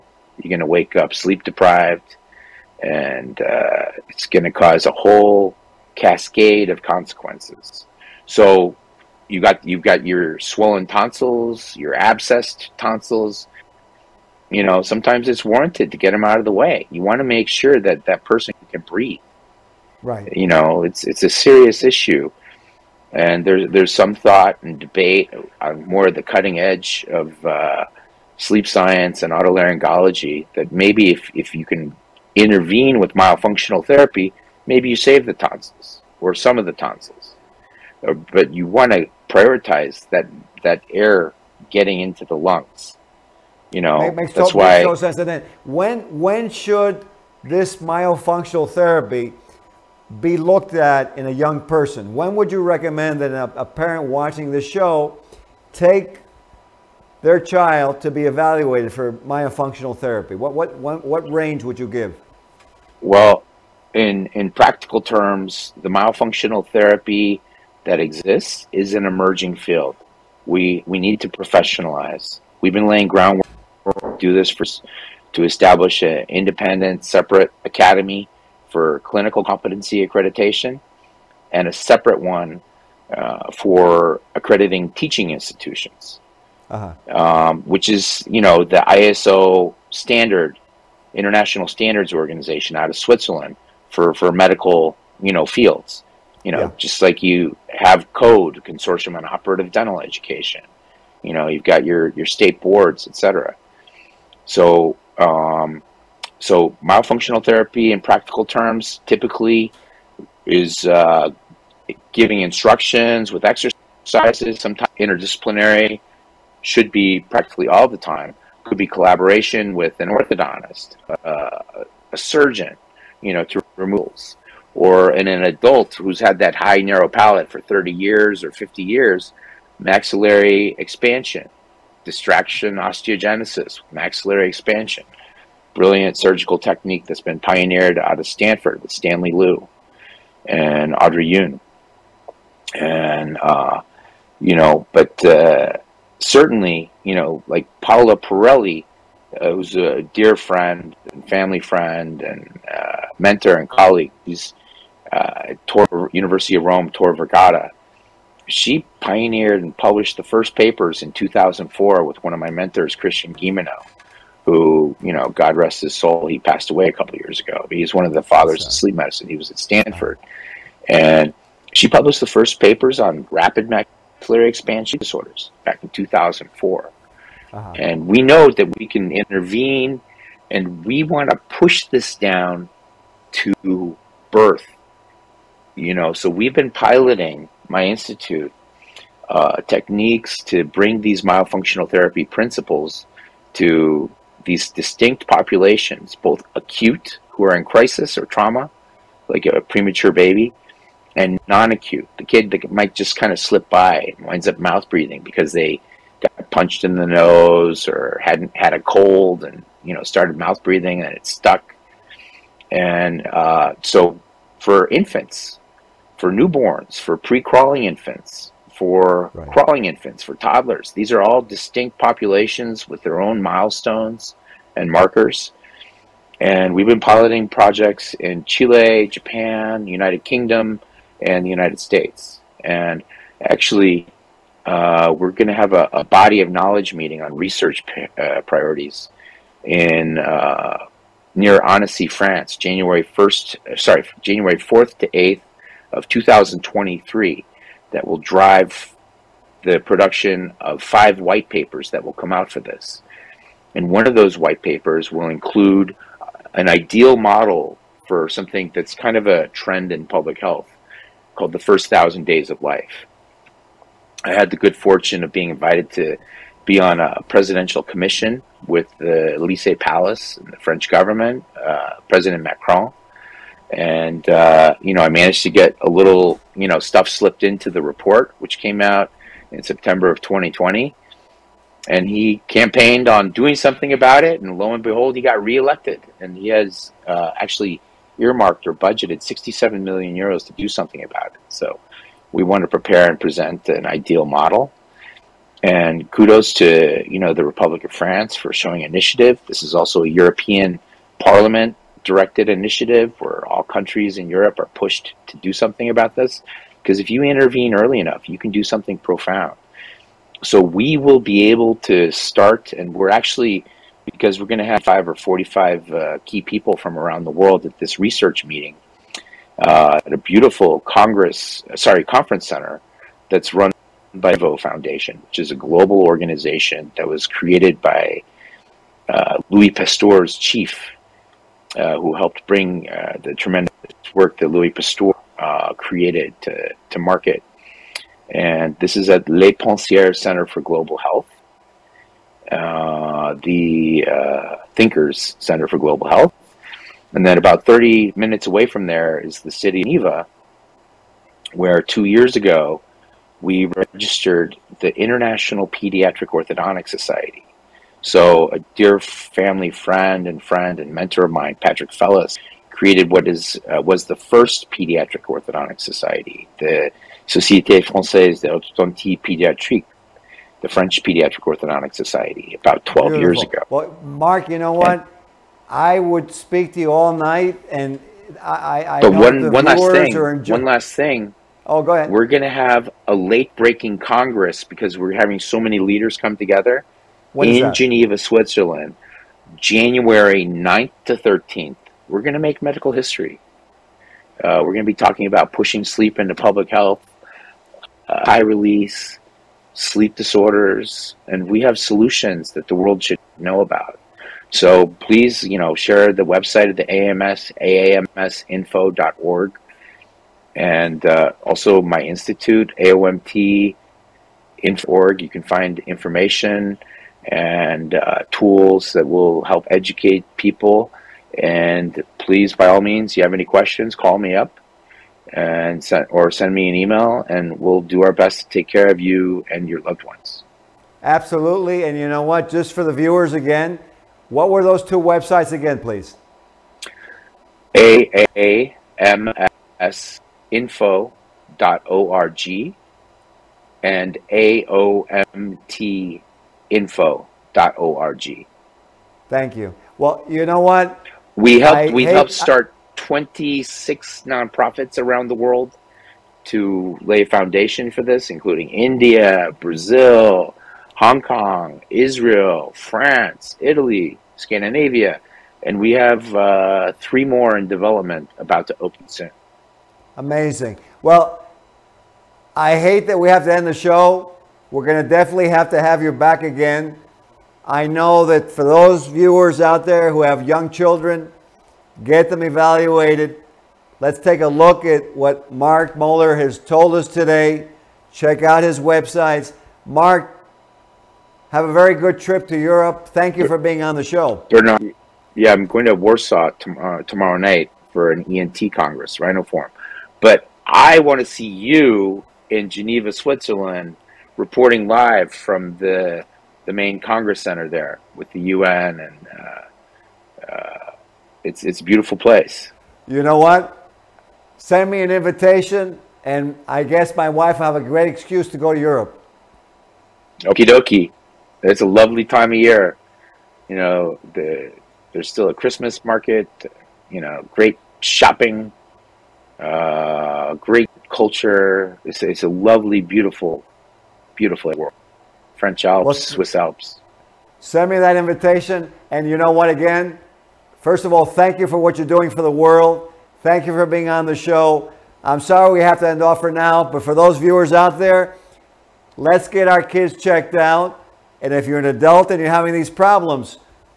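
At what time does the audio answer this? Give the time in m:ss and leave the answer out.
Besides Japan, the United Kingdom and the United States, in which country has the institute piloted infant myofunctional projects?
3:48.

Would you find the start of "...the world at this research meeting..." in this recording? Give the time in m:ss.
5:17.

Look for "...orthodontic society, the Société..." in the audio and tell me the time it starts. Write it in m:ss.
6:05.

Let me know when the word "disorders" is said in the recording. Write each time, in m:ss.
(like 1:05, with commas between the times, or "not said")
2:54, 6:40.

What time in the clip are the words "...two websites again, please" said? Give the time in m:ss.
7:14.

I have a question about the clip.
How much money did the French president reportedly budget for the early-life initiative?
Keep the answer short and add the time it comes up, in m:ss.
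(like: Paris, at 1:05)
67 million euros, at 4:49.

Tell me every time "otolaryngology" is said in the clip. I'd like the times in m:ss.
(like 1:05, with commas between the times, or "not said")
0:29.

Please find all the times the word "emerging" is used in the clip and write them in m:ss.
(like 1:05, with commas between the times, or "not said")
1:09.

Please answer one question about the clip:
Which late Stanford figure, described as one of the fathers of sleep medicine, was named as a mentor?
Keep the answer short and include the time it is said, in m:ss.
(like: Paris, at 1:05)
Christian Guilleminault, at 2:42.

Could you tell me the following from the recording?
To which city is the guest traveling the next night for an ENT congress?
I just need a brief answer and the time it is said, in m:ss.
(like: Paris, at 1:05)
Warsaw, at 8:15.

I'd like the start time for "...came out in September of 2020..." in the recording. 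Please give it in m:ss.
4:38.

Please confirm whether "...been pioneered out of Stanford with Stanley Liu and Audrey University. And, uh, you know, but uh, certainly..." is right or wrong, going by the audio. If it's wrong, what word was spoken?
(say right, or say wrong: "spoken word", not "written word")
wrong: "Yoon", not "University".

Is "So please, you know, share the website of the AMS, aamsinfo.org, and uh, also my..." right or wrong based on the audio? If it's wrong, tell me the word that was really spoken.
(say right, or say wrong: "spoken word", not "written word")
right.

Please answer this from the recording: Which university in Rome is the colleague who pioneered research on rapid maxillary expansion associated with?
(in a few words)
Tor Vergata.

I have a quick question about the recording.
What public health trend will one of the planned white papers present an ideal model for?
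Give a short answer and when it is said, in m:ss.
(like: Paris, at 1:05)
first thousand days of life, at 4:21.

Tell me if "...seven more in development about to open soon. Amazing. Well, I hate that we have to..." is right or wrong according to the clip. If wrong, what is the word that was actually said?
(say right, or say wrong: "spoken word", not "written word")
wrong: "three", not "seven".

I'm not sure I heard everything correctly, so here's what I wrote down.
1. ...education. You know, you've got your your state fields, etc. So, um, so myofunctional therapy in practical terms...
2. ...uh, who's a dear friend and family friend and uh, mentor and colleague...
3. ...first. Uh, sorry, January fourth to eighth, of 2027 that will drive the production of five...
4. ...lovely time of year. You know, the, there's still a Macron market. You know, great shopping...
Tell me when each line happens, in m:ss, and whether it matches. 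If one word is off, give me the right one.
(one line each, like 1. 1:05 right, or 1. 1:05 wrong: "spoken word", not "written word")
1. 1:40 wrong: "boards", not "fields"
2. 2:29 right
3. 4:03 wrong: "2023", not "2027"
4. 8:41 wrong: "Christmas", not "Macron".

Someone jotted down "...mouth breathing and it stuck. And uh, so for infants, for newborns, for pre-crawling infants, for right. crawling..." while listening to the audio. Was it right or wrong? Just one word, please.
right.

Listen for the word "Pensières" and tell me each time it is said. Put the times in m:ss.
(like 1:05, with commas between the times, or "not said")
5:39.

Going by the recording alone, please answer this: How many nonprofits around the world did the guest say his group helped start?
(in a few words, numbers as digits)
26.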